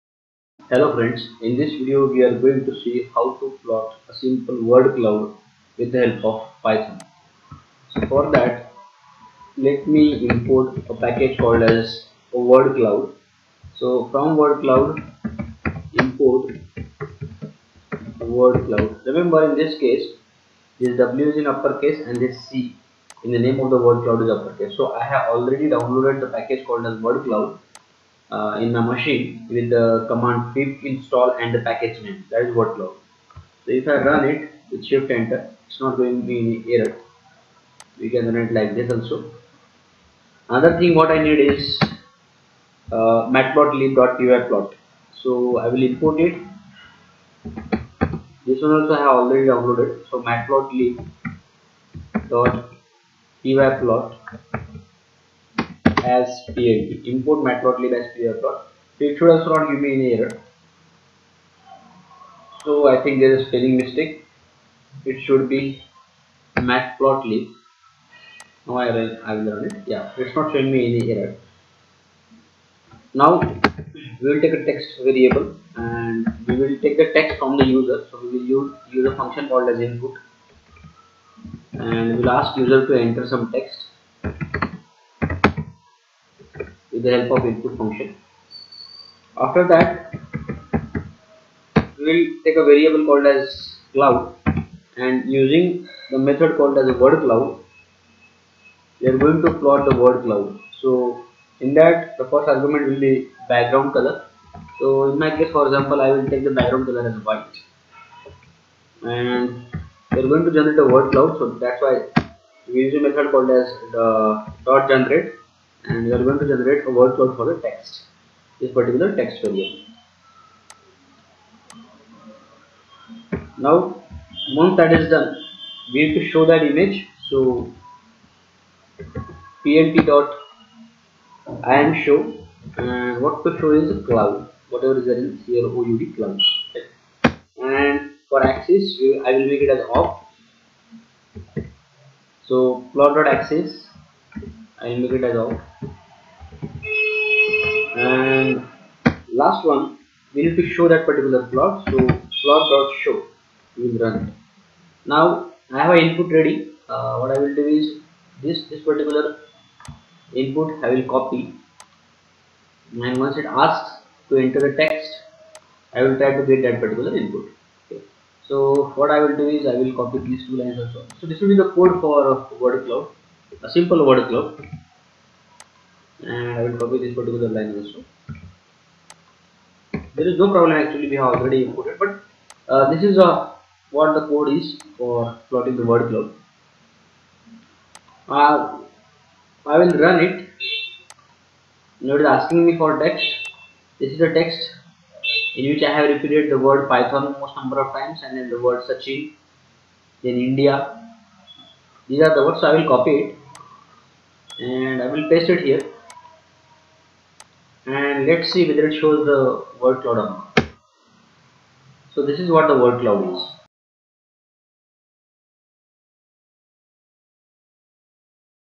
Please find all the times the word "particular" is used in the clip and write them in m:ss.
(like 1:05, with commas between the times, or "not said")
1:58, 2:31, 2:38, 2:46, 2:57.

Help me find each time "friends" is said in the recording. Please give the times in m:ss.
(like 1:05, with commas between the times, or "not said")
0:00.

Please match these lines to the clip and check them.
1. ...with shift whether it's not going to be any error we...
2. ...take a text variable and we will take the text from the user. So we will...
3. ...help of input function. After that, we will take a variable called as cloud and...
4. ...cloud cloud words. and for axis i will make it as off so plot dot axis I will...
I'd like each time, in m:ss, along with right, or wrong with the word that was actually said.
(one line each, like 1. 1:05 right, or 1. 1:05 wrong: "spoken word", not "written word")
1. 0:34 wrong: "enter", not "whether"
2. 1:14 right
3. 1:27 right
4. 2:15 wrong: "clouds", not "words".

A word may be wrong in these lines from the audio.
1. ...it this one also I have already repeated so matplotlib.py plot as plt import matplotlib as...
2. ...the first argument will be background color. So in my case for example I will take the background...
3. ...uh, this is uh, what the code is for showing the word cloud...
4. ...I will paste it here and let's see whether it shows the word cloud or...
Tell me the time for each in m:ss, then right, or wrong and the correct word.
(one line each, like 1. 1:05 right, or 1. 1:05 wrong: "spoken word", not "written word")
1. 0:46 wrong: "downloaded", not "repeated"
2. 1:42 right
3. 3:02 wrong: "plotting", not "showing"
4. 3:25 right.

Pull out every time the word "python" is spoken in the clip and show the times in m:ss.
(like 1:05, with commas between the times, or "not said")
0:06, 3:16.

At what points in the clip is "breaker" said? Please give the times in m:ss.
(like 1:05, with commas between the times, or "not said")
not said.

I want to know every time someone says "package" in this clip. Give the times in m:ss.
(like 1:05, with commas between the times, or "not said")
0:10, 0:26, 0:31.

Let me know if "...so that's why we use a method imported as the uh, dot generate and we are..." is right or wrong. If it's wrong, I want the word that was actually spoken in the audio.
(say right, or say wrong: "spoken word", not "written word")
wrong: "called", not "imported".